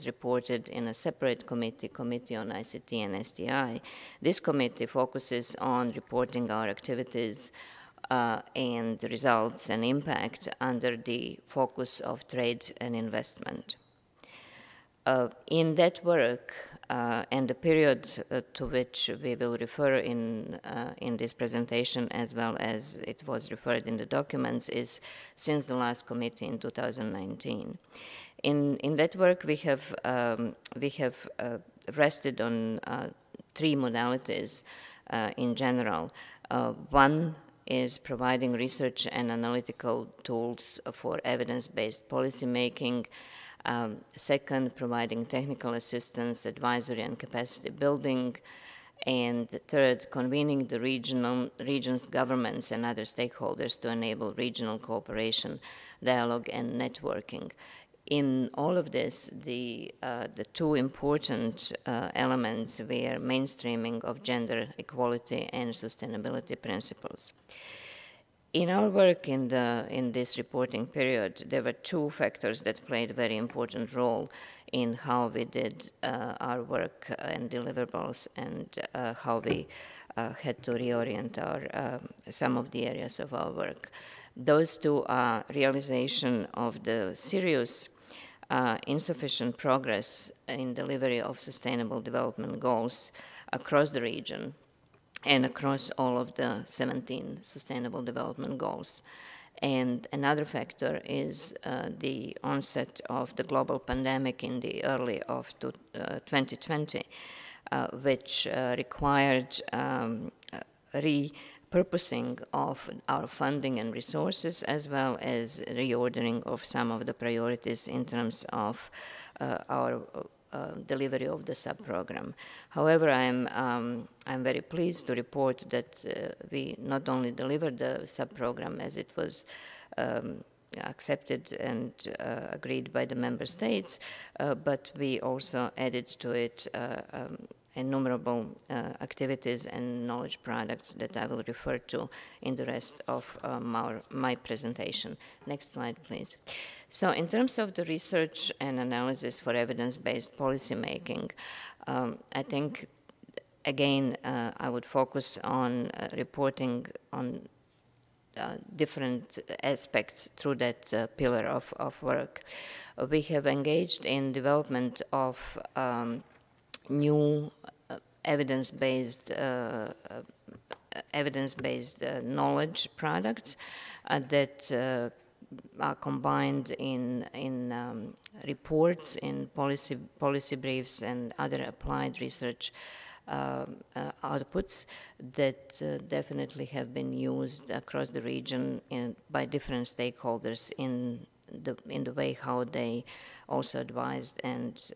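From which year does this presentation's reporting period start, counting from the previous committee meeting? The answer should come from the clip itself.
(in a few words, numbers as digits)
2019.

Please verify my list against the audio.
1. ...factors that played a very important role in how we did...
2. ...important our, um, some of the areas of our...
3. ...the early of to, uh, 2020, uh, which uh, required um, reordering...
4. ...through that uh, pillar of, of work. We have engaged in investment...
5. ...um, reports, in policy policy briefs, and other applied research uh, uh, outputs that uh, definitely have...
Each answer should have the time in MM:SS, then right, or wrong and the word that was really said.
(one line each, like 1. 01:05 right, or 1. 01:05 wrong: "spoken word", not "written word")
1. 01:12 right
2. 01:20 wrong: "reorient", not "important"
3. 01:44 wrong: "repurposing", not "reordering"
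4. 02:40 wrong: "development", not "investment"
5. 02:57 right.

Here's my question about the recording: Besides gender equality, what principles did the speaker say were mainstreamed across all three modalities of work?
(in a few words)
sustainability principles.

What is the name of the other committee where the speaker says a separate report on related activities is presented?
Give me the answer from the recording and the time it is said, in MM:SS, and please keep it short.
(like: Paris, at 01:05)
Committee on ICT and STI, at 00:01.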